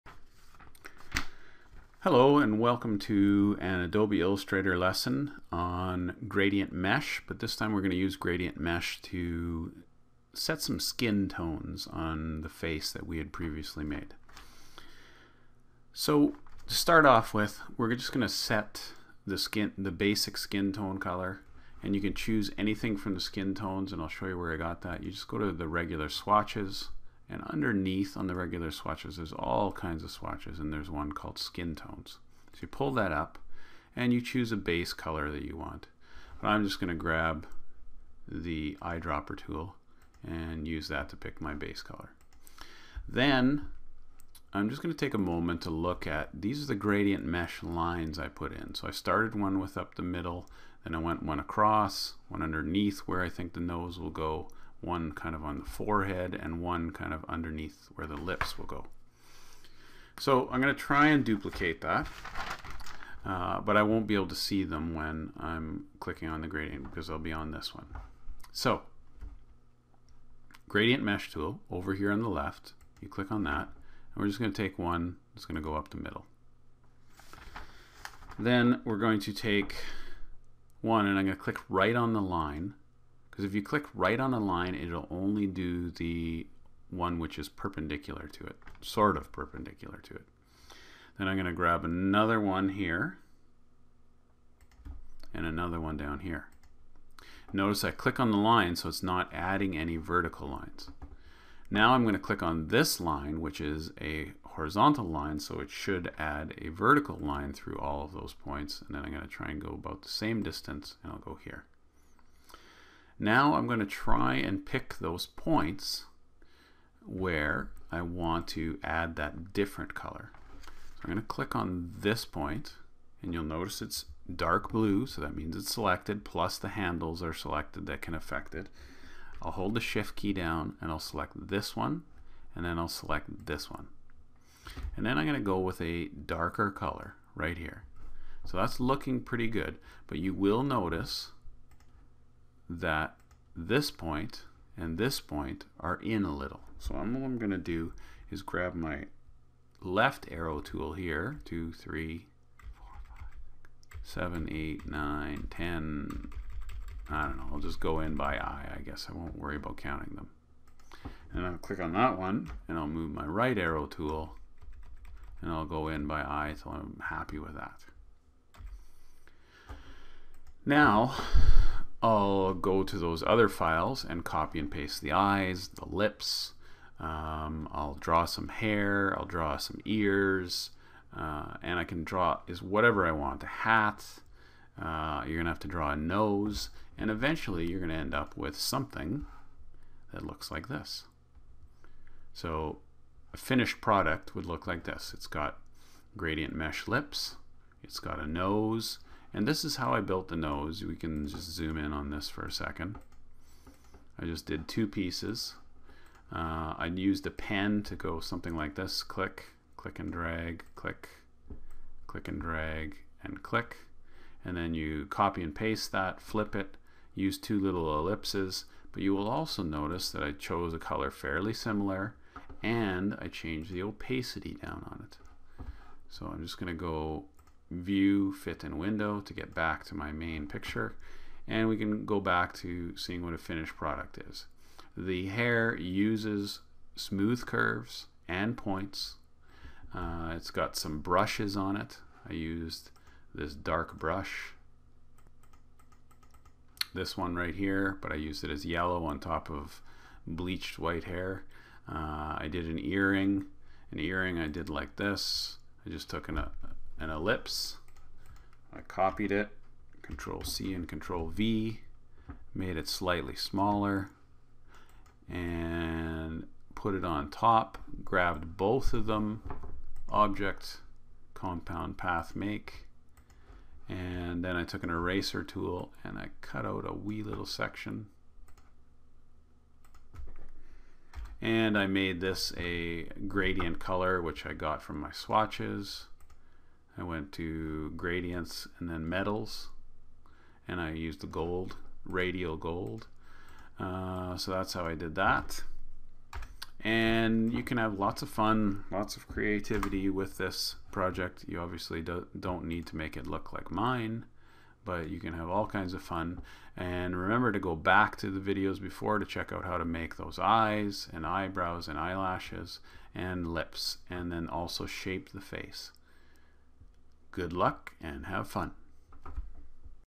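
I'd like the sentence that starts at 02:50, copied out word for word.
Now, I'll go to those other files and copy and paste the eyes, the lips.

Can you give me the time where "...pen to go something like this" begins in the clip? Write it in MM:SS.
03:27.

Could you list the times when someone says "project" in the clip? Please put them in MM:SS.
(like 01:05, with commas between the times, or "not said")
05:00.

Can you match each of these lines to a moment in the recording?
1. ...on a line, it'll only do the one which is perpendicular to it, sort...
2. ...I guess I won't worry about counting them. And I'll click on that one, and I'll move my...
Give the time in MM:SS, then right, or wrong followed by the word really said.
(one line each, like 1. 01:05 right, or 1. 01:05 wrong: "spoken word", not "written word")
1. 01:24 right
2. 02:38 right.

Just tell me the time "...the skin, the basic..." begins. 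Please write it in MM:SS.
00:19.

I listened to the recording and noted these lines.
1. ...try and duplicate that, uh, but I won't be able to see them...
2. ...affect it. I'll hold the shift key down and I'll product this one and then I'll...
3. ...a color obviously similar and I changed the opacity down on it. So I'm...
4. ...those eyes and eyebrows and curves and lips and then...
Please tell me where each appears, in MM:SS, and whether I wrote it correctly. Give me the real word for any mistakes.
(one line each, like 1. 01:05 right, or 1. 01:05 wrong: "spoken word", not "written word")
1. 01:00 right
2. 02:08 wrong: "select", not "product"
3. 03:40 wrong: "fairly", not "obviously"
4. 05:10 wrong: "eyelashes", not "curves".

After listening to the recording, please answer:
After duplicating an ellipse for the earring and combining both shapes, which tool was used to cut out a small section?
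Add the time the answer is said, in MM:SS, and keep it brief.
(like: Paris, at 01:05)
eraser tool, at 04:34.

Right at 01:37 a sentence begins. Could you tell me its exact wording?
Notice I click on the line so it's not adding any vertical lines.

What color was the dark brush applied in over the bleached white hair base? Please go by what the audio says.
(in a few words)
yellow.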